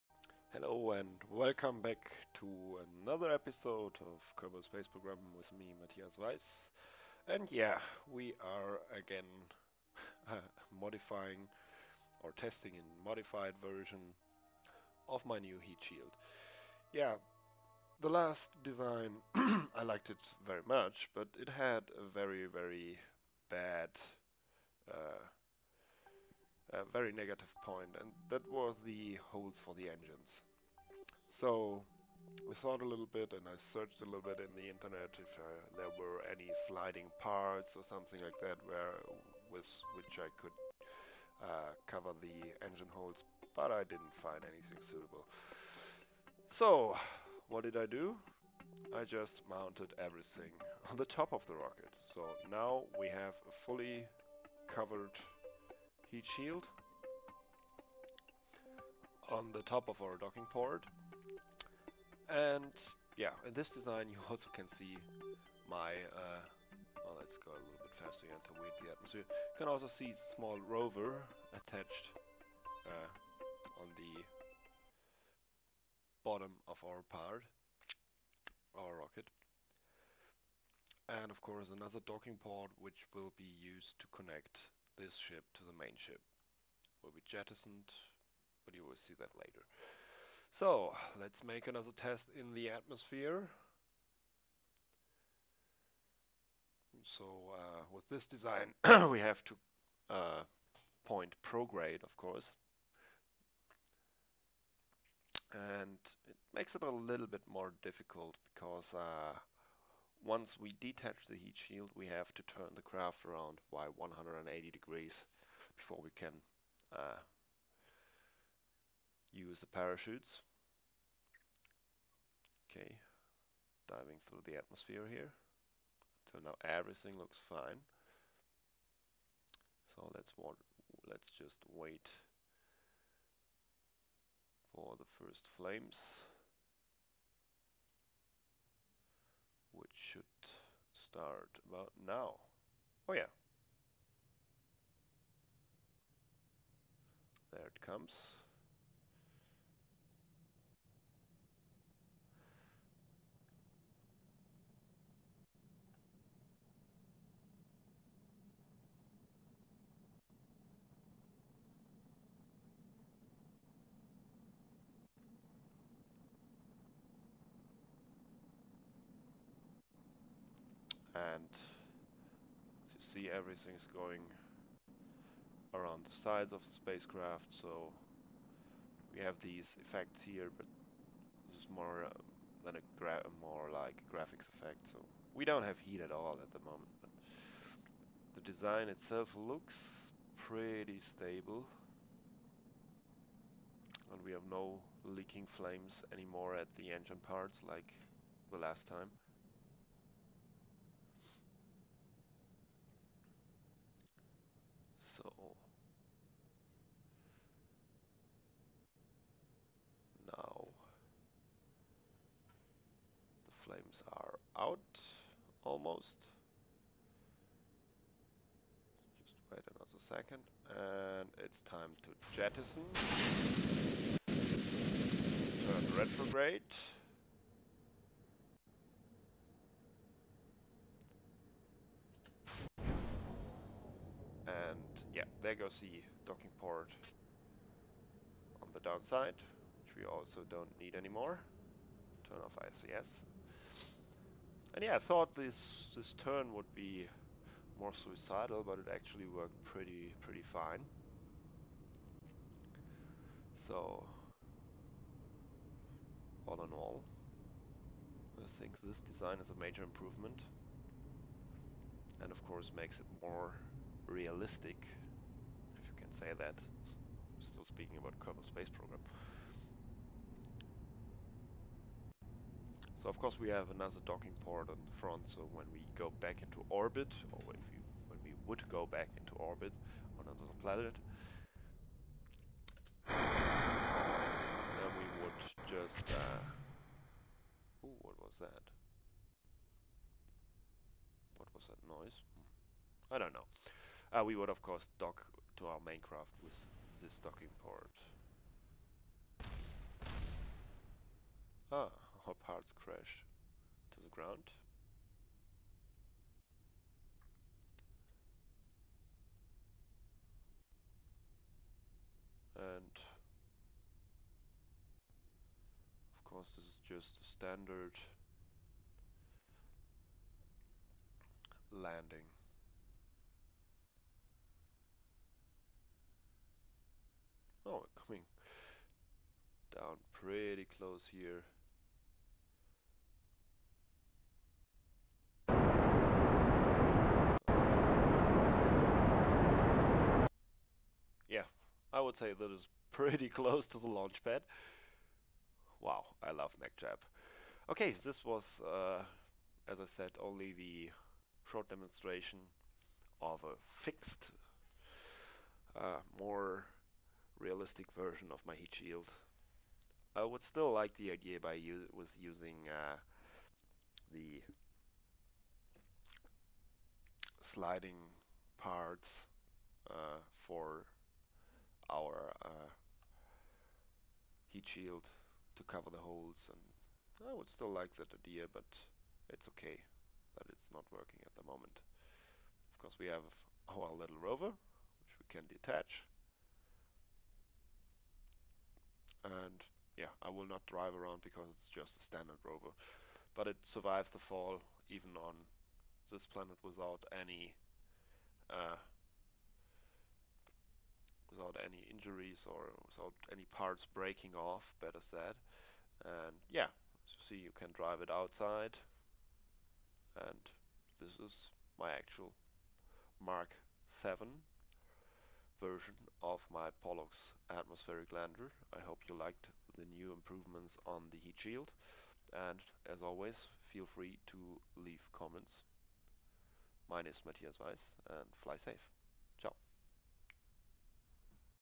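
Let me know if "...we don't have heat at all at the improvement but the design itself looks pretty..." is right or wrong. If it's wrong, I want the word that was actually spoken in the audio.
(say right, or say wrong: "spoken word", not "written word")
wrong: "moment", not "improvement".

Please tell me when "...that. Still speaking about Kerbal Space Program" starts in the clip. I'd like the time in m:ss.
4:26.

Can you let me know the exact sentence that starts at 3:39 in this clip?
Just wait another second and it's time to jettison.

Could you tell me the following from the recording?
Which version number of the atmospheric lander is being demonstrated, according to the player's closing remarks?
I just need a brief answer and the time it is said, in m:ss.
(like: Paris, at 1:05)
Mark 7, at 6:53.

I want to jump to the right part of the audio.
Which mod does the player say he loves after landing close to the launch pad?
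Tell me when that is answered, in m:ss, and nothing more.
5:46.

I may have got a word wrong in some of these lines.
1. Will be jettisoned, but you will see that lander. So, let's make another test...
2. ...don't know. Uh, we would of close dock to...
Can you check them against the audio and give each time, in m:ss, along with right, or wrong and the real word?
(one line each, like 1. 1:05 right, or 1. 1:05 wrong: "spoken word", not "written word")
1. 1:27 wrong: "later", not "lander"
2. 4:53 wrong: "course", not "close".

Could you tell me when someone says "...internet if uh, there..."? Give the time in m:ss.
0:34.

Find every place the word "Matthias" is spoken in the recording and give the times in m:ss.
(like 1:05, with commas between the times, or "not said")
0:05, 7:07.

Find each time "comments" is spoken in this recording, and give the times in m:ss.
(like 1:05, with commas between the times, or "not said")
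7:05.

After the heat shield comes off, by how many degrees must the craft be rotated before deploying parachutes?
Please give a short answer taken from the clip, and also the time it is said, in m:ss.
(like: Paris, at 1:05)
180, at 1:53.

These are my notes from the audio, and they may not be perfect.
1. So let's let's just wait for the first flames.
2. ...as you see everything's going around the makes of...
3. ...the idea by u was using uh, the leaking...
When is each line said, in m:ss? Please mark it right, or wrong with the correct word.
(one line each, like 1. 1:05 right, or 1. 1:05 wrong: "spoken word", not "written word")
1. 2:09 right
2. 2:52 wrong: "sides", not "makes"
3. 6:00 wrong: "sliding", not "leaking".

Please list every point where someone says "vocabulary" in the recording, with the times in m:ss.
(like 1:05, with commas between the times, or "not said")
not said.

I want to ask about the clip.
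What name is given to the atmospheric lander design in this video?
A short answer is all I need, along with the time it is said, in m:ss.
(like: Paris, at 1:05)
Pollux, at 6:56.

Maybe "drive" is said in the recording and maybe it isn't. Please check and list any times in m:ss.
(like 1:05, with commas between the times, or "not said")
6:30, 6:47.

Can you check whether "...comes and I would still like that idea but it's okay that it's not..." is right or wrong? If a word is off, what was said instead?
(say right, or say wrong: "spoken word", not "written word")
wrong: "holes", not "comes".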